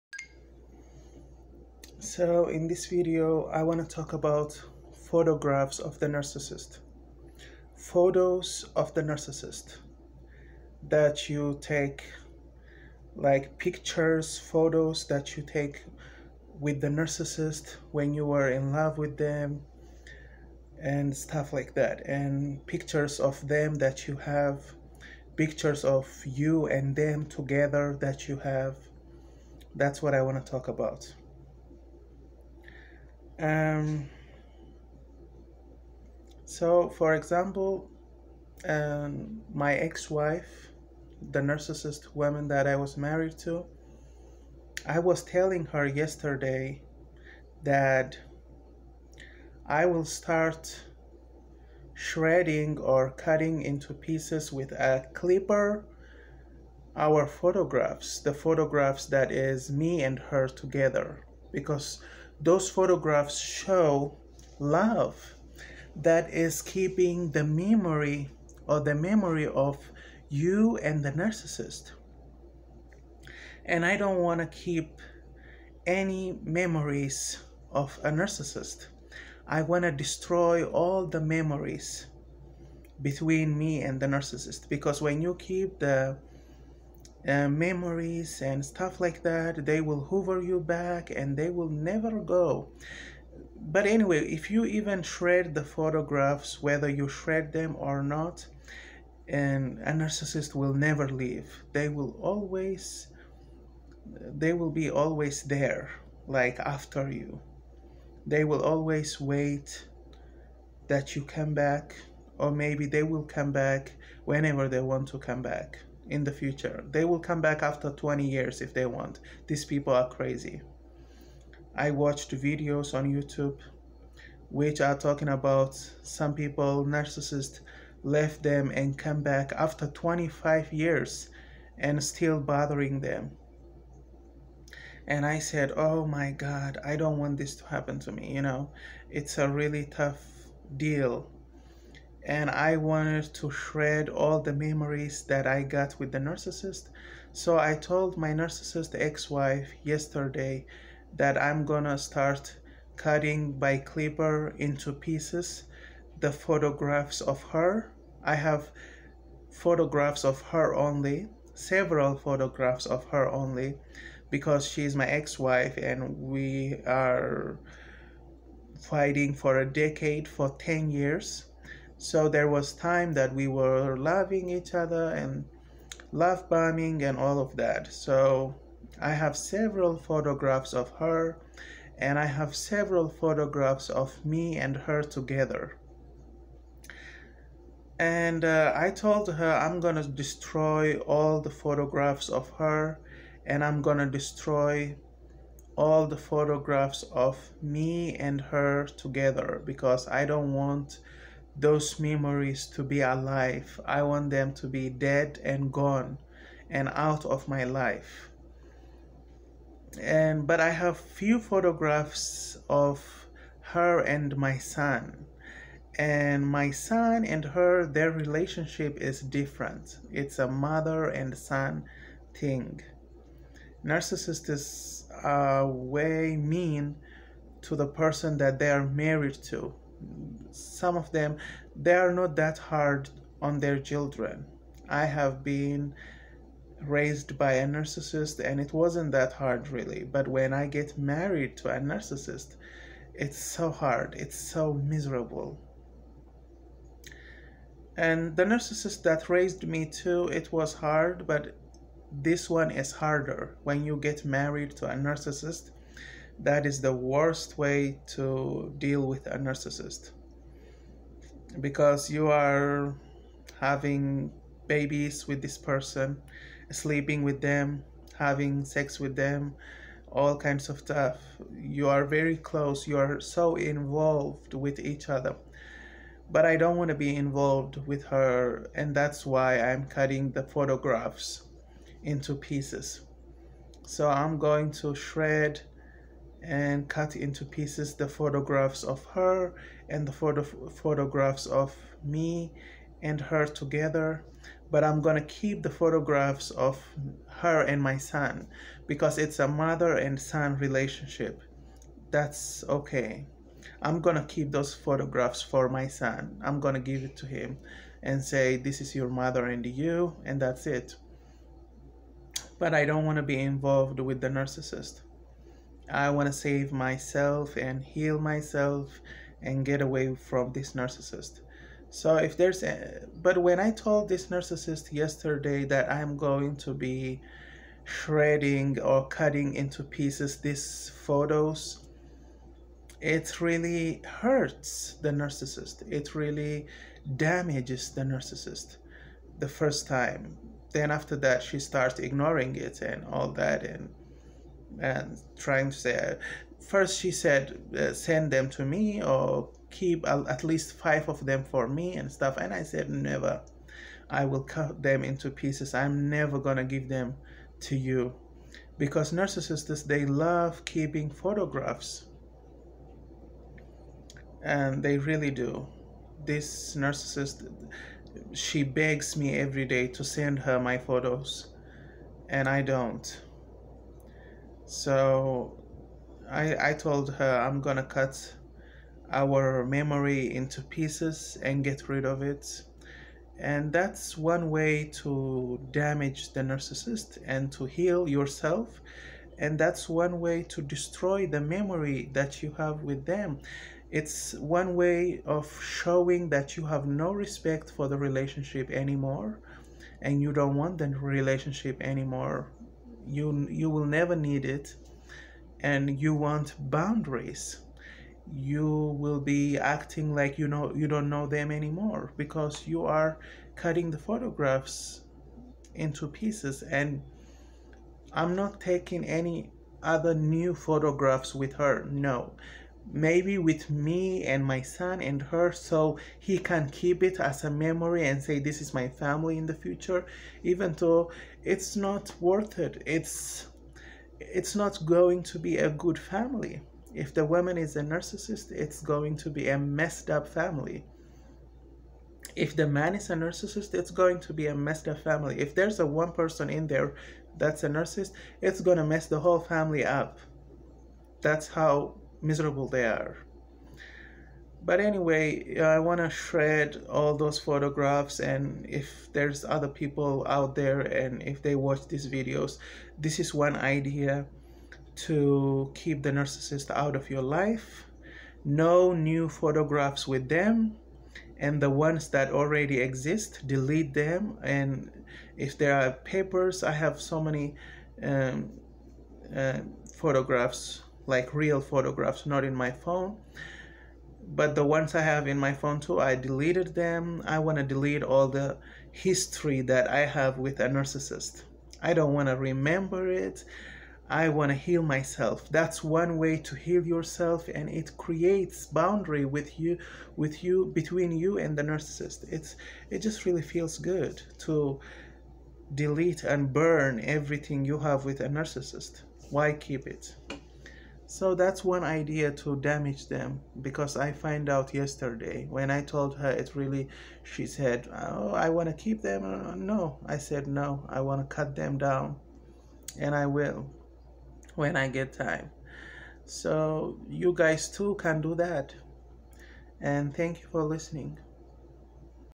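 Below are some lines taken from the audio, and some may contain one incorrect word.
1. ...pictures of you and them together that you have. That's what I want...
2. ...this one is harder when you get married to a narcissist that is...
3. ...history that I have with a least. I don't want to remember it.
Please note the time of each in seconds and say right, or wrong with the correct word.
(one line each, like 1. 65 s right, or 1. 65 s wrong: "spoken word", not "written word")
1. 25 s right
2. 252 s right
3. 488 s wrong: "narcissist", not "least".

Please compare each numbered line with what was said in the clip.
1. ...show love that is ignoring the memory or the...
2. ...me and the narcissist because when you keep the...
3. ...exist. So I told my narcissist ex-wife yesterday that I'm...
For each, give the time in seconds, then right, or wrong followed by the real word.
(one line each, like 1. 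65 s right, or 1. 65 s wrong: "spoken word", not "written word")
1. 63 s wrong: "keeping", not "ignoring"
2. 83 s right
3. 146 s wrong: "narcissist", not "exist".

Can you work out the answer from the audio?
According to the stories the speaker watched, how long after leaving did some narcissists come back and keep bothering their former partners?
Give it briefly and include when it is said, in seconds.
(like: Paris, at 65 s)
25 years, at 129 s.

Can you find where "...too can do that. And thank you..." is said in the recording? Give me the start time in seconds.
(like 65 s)
527 s.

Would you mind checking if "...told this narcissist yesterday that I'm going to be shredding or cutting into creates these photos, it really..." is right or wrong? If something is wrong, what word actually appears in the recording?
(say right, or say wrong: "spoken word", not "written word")
wrong: "pieces", not "creates".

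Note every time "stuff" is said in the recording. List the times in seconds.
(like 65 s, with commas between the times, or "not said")
21 s, 88 s, 270 s, 352 s.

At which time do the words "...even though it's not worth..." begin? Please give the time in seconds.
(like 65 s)
430 s.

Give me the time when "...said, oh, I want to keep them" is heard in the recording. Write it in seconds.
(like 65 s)
517 s.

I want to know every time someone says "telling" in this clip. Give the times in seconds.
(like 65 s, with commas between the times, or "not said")
45 s.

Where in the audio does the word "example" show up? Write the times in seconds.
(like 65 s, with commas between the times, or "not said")
37 s.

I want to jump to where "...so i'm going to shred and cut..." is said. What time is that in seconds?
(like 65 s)
283 s.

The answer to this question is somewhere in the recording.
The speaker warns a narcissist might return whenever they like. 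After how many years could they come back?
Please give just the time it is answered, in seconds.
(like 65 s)
117 s.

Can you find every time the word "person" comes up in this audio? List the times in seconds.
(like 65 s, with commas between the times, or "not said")
227 s, 265 s, 446 s.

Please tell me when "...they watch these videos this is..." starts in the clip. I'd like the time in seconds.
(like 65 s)
461 s.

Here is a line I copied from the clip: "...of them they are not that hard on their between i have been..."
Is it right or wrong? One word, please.
wrong.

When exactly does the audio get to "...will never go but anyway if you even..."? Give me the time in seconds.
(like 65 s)
91 s.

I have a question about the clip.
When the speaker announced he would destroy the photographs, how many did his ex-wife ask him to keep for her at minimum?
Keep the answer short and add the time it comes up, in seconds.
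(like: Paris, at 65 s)
5, at 350 s.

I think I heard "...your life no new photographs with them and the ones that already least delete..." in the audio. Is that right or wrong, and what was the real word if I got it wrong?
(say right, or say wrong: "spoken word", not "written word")
wrong: "exist", not "least".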